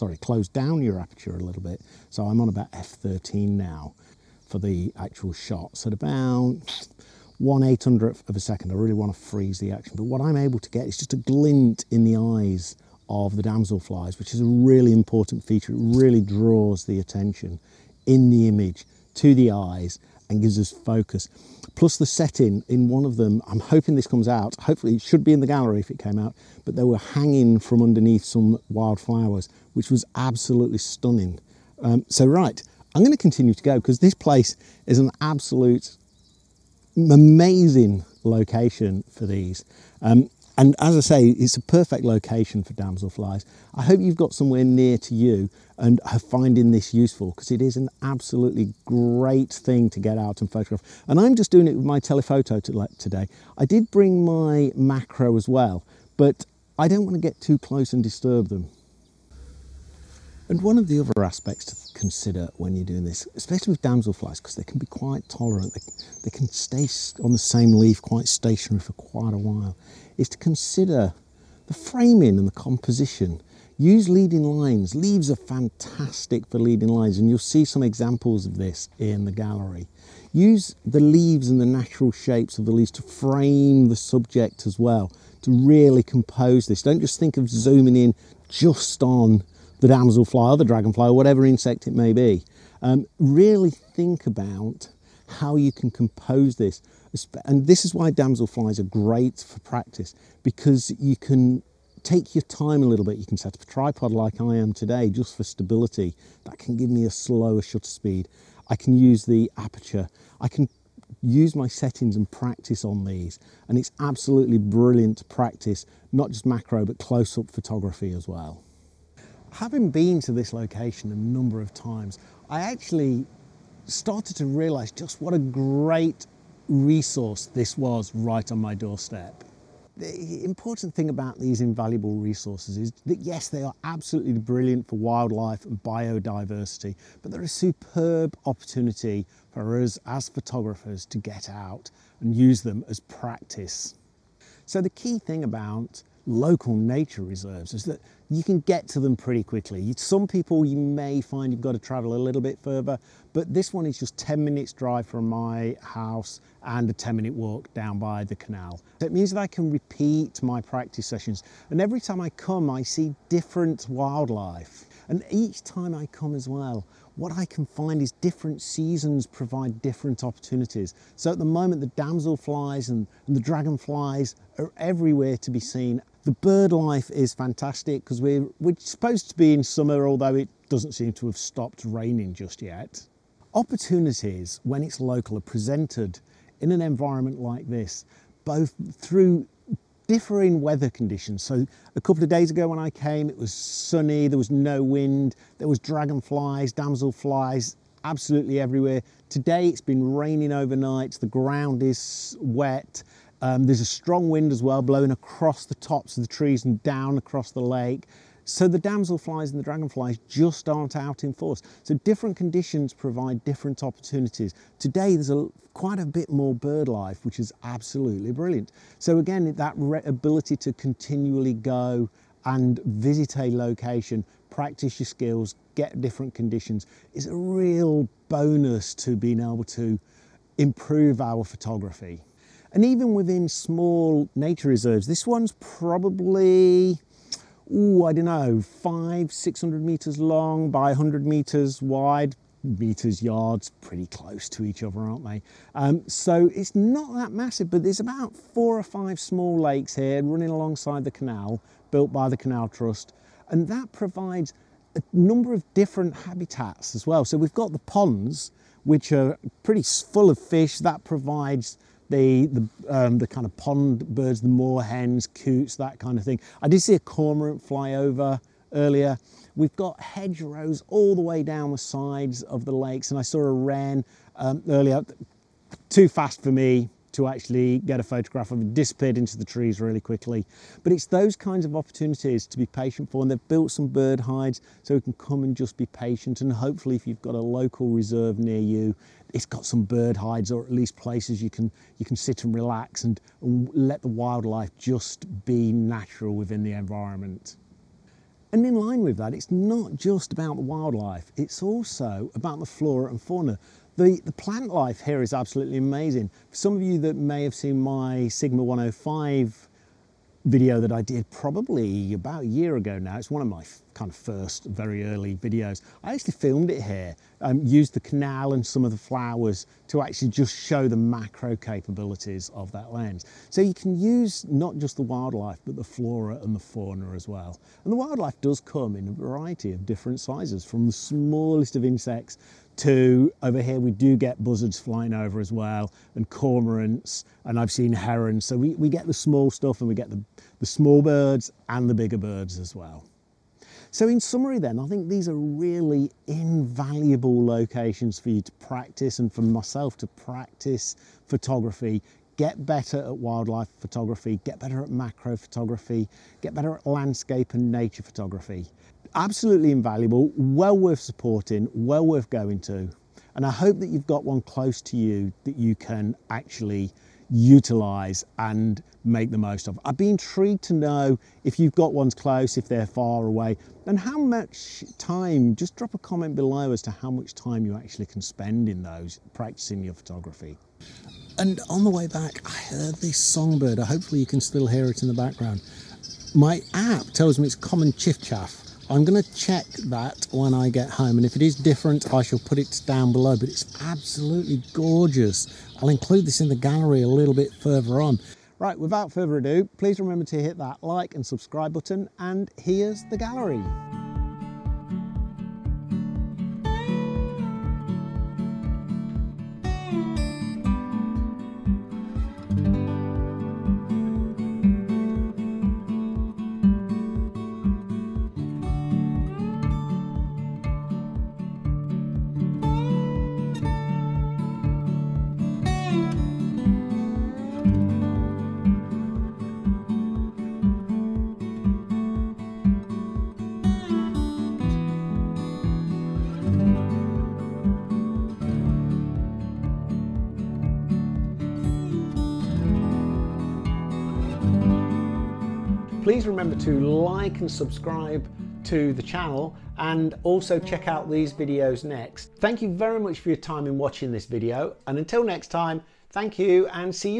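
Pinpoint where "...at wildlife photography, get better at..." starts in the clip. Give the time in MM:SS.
05:53.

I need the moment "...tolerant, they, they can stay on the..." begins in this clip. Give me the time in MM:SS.
01:05.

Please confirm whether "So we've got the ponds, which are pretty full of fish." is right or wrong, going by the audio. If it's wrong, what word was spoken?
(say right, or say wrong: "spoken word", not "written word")
right.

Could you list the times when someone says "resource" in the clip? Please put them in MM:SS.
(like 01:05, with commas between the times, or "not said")
02:06, 02:12.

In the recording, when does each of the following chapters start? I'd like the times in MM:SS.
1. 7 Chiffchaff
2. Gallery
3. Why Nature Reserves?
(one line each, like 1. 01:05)
1. 06:16
2. 06:36
3. 01:56.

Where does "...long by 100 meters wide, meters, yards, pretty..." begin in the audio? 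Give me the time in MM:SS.
04:00.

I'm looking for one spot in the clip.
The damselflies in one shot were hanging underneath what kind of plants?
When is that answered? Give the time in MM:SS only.
00:28.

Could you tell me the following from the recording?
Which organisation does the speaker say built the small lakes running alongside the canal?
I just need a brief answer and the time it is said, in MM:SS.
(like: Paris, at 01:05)
Canal Trust, at 04:12.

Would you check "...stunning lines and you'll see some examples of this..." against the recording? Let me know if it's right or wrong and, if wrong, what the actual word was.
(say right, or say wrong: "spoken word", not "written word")
wrong: "leading", not "stunning".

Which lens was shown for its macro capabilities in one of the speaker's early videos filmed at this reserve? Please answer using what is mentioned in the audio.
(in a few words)
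Sigma 105.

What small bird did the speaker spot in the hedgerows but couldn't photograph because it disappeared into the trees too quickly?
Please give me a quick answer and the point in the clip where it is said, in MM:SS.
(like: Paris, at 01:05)
wren, at 04:33.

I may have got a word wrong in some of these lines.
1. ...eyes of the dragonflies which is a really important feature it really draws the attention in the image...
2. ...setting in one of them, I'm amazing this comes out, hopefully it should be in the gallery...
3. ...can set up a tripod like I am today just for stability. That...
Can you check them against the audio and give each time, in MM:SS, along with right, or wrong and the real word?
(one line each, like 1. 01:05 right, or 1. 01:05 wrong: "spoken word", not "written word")
1. 00:12 wrong: "damselflies", not "dragonflies"
2. 00:22 wrong: "hoping", not "amazing"
3. 01:43 right.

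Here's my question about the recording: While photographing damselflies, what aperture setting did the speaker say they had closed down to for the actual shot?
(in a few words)
f13.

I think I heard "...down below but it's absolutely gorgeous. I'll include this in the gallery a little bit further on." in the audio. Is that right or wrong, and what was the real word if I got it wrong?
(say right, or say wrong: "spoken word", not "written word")
right.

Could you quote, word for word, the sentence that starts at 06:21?
And on the way back, I heard this songbird.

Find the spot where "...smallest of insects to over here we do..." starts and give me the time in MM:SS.
05:30.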